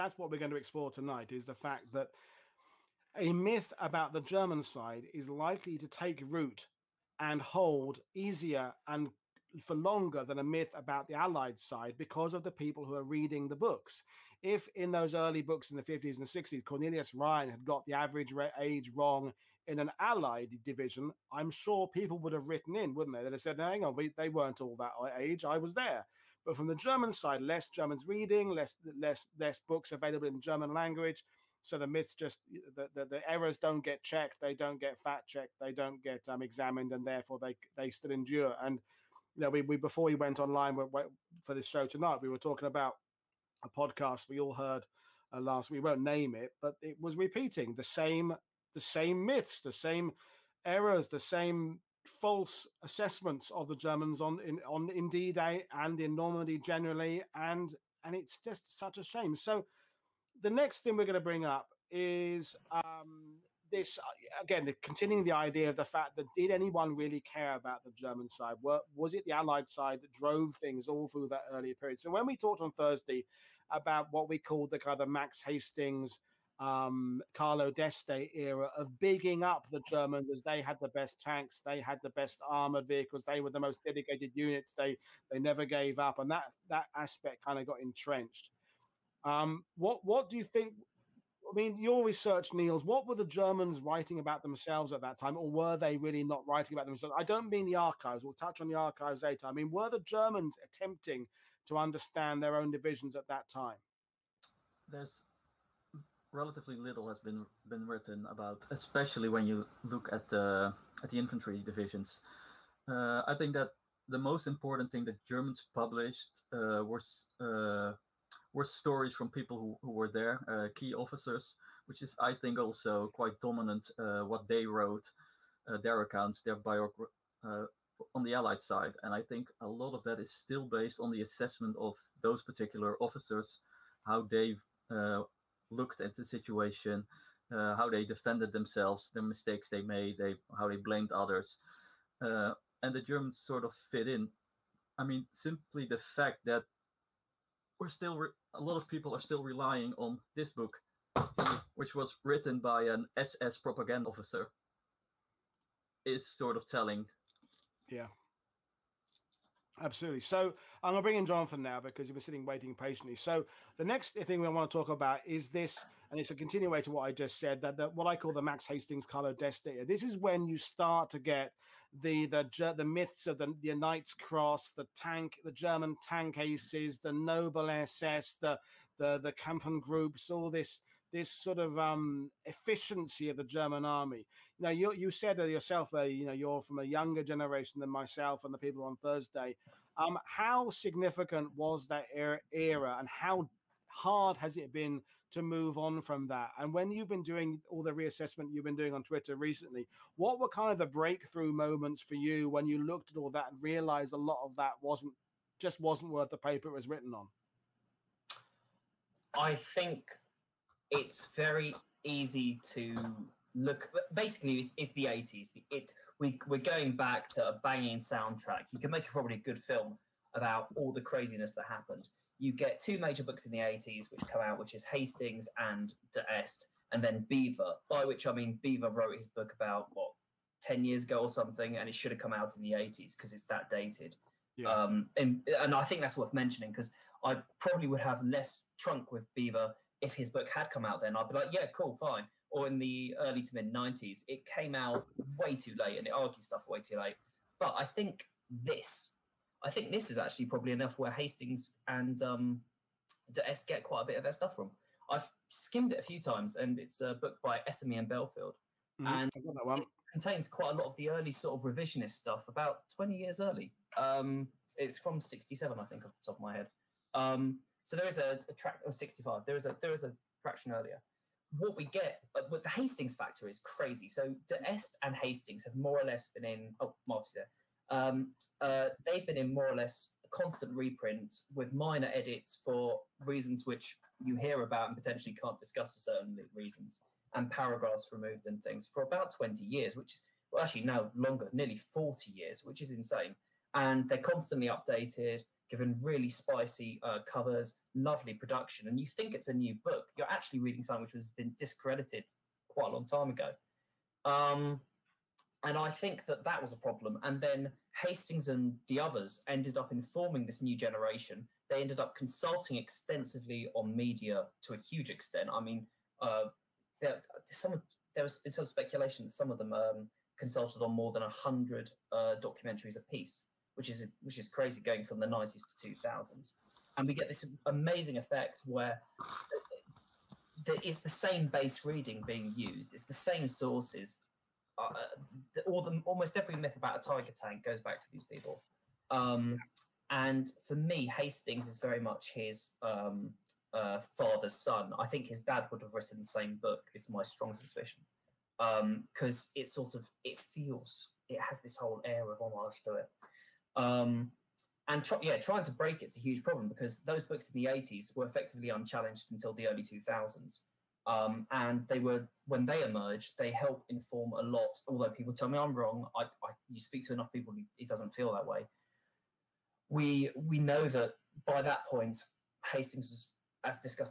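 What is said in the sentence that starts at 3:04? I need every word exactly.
You know, you, you said yourself, uh, you know, you're from a younger generation than myself and the people on Thursday.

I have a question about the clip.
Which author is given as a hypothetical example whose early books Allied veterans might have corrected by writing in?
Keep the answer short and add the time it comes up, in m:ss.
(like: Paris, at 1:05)
Cornelius Ryan, at 0:16.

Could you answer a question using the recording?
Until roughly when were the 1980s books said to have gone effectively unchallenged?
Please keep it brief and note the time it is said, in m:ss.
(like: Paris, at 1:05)
early 2000s, at 5:59.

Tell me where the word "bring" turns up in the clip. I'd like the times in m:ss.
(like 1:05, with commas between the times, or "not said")
1:01, 2:41.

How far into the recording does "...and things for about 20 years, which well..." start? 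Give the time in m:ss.
4:48.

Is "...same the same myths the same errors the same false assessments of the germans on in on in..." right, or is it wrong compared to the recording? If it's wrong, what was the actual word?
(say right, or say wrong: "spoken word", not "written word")
right.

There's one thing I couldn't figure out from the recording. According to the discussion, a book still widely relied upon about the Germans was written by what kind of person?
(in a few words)
SS propaganda officer.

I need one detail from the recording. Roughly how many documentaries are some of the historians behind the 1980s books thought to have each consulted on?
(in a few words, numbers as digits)
100.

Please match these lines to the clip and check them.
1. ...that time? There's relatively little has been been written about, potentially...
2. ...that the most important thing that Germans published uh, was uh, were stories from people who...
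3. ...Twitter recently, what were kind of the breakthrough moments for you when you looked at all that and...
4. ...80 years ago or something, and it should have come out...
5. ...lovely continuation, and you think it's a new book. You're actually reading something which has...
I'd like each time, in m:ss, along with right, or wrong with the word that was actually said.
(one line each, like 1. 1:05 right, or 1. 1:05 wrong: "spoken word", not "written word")
1. 1:43 wrong: "especially", not "potentially"
2. 1:53 right
3. 3:19 right
4. 3:50 wrong: "10", not "80"
5. 4:57 wrong: "production", not "continuation".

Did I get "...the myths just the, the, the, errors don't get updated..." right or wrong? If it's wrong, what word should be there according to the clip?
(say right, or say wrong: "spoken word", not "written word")
wrong: "checked", not "updated".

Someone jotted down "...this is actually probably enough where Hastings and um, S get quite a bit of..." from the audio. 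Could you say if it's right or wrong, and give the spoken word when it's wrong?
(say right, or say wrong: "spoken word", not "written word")
right.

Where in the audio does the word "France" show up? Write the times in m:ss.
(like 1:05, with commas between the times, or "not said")
not said.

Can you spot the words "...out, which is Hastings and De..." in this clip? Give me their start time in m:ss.
3:44.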